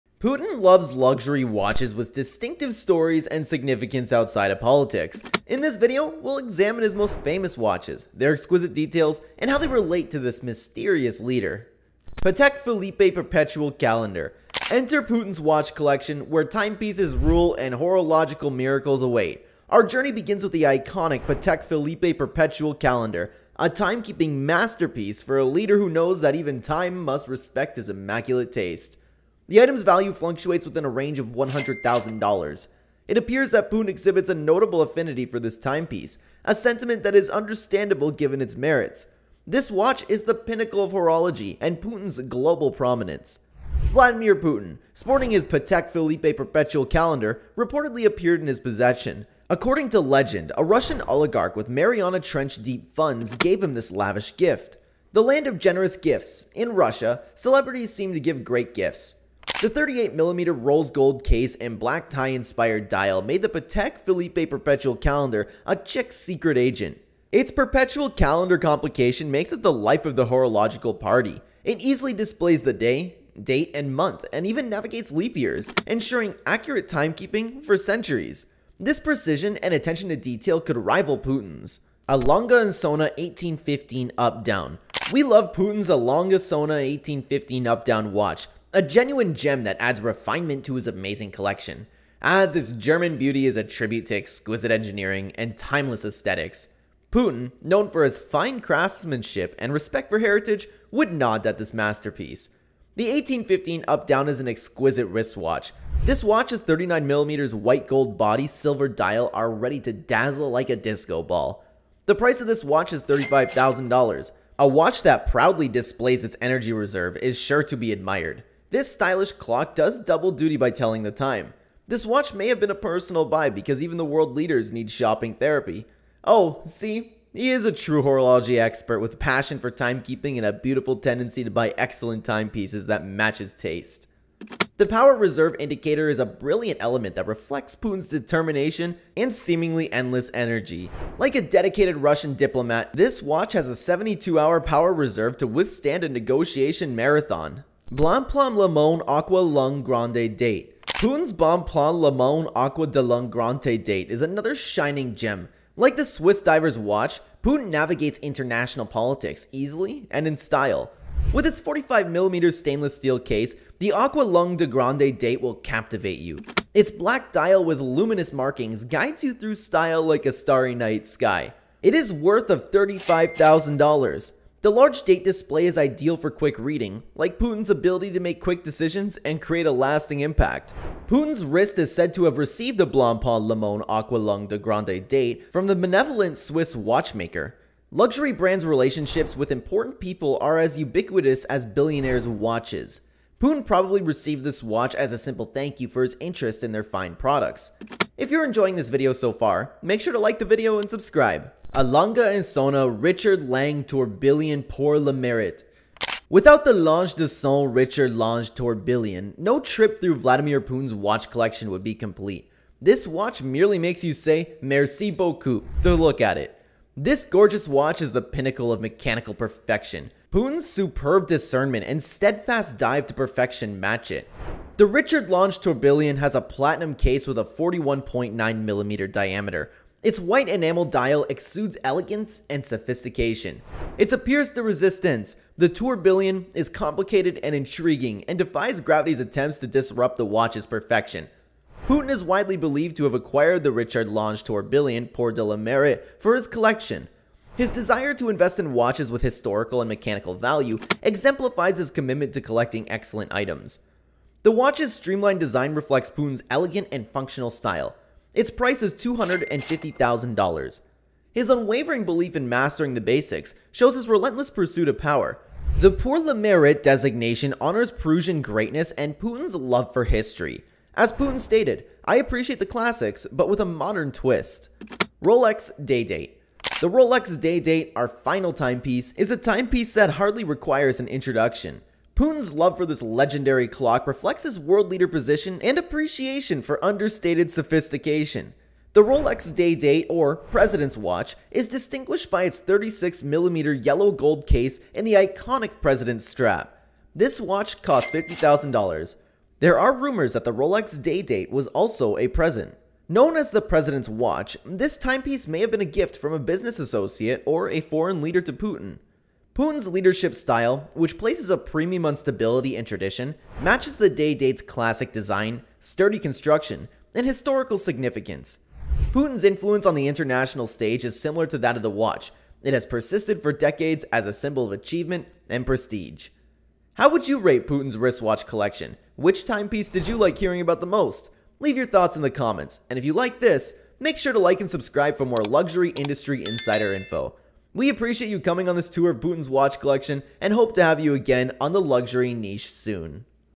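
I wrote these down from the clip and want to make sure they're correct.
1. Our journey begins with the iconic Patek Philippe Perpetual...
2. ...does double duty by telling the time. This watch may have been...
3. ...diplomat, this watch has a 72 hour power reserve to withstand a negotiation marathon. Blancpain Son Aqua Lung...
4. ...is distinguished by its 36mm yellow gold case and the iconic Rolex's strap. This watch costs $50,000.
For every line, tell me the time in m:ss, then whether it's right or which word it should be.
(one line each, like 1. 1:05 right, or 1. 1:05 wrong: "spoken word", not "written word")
1. 0:19 right
2. 1:59 right
3. 2:22 wrong: "Léman", not "Son"
4. 4:51 wrong: "President", not "Rolex".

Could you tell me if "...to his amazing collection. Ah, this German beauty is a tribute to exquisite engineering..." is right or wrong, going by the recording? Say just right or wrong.
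right.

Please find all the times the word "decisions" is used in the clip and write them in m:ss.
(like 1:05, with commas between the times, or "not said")
2:58.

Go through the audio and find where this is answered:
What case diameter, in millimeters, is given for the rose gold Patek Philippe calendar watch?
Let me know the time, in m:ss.
0:59.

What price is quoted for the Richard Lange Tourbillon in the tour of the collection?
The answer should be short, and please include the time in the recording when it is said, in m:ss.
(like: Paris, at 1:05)
$250,000, at 4:18.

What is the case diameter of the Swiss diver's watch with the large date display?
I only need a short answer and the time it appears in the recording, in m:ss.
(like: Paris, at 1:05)
45mm, at 2:41.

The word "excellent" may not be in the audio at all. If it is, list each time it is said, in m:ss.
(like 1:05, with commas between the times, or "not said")
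2:11, 4:12.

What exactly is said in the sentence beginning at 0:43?
Vladimir Putin, sporting his Patek Philippe perpetual calendar, reportedly appeared in his possession.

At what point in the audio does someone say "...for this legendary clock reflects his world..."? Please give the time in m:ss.
4:42.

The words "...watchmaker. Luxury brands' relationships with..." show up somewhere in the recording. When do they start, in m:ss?
3:06.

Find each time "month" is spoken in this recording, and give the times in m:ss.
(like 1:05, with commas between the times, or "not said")
1:13.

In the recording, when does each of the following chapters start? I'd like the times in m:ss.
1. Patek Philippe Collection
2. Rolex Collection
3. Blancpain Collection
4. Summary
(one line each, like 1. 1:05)
1. 0:13
2. 4:36
3. 1:22
4. 5:30.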